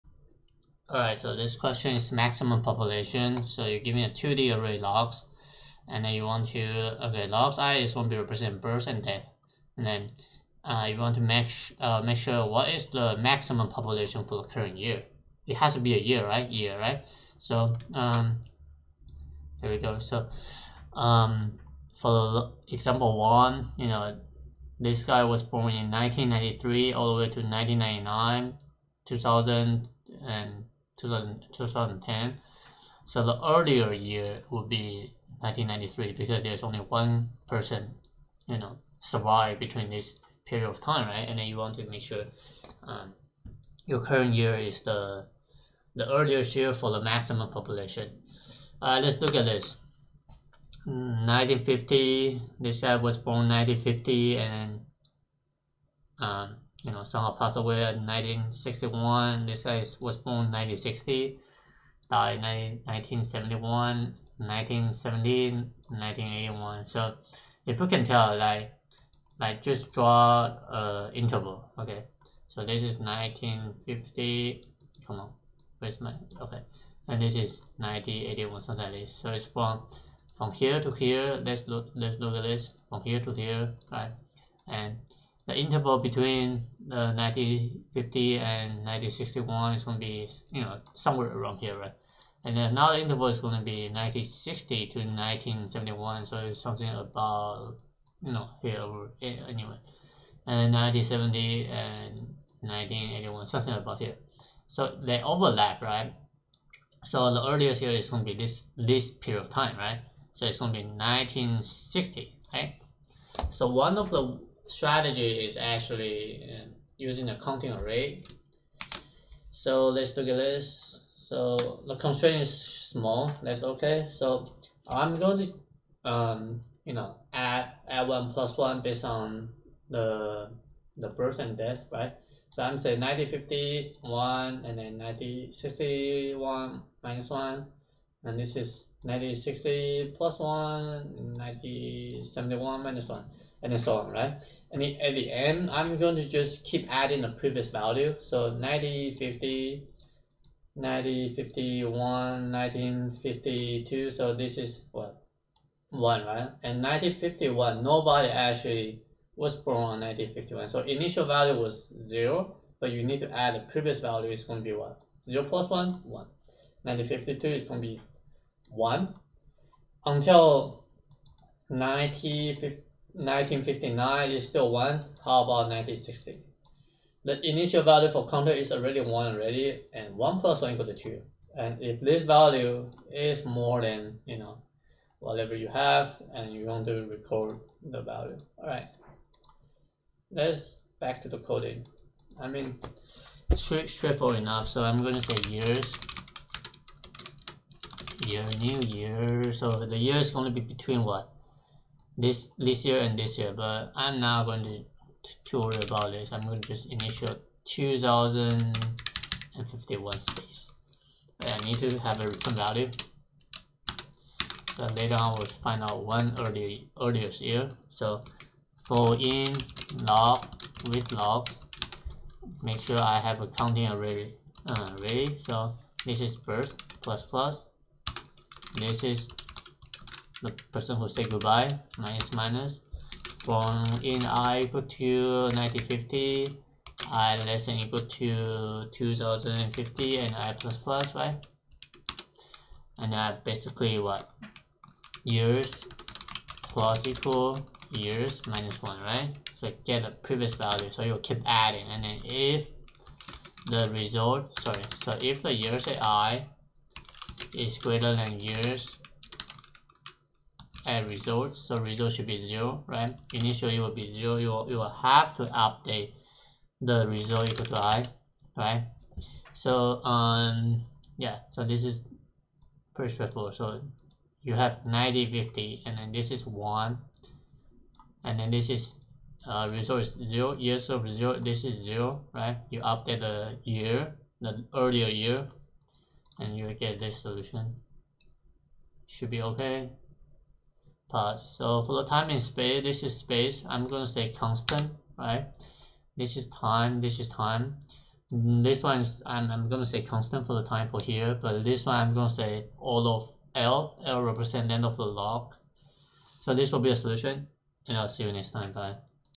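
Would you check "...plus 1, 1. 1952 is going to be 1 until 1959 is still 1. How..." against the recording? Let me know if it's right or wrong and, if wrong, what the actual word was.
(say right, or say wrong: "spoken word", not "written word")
right.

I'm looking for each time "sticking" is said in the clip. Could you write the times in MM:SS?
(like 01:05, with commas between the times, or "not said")
not said.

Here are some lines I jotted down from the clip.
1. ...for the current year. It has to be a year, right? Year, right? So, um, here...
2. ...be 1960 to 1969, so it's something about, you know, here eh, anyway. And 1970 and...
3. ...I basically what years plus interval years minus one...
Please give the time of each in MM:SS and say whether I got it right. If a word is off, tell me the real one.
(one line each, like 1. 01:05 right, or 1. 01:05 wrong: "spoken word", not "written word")
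1. 00:14 right
2. 01:33 wrong: "1971", not "1969"
3. 04:03 wrong: "equal", not "interval".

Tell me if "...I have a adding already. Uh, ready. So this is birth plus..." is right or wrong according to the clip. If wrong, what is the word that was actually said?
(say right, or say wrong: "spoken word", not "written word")
wrong: "counting", not "adding".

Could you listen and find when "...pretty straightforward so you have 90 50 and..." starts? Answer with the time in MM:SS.
04:32.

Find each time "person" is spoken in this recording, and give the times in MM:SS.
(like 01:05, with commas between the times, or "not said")
00:37, 03:50.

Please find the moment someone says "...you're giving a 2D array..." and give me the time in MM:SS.
00:03.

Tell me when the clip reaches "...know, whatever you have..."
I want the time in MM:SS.
03:04.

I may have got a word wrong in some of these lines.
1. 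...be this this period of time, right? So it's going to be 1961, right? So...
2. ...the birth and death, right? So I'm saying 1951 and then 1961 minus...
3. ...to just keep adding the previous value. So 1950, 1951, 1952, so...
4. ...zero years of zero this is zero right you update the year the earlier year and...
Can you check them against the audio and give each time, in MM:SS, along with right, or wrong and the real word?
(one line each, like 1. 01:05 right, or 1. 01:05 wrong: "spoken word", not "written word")
1. 01:48 wrong: "1960", not "1961"
2. 02:10 right
3. 02:26 right
4. 04:40 right.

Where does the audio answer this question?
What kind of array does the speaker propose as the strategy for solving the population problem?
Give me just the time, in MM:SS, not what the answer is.
01:56.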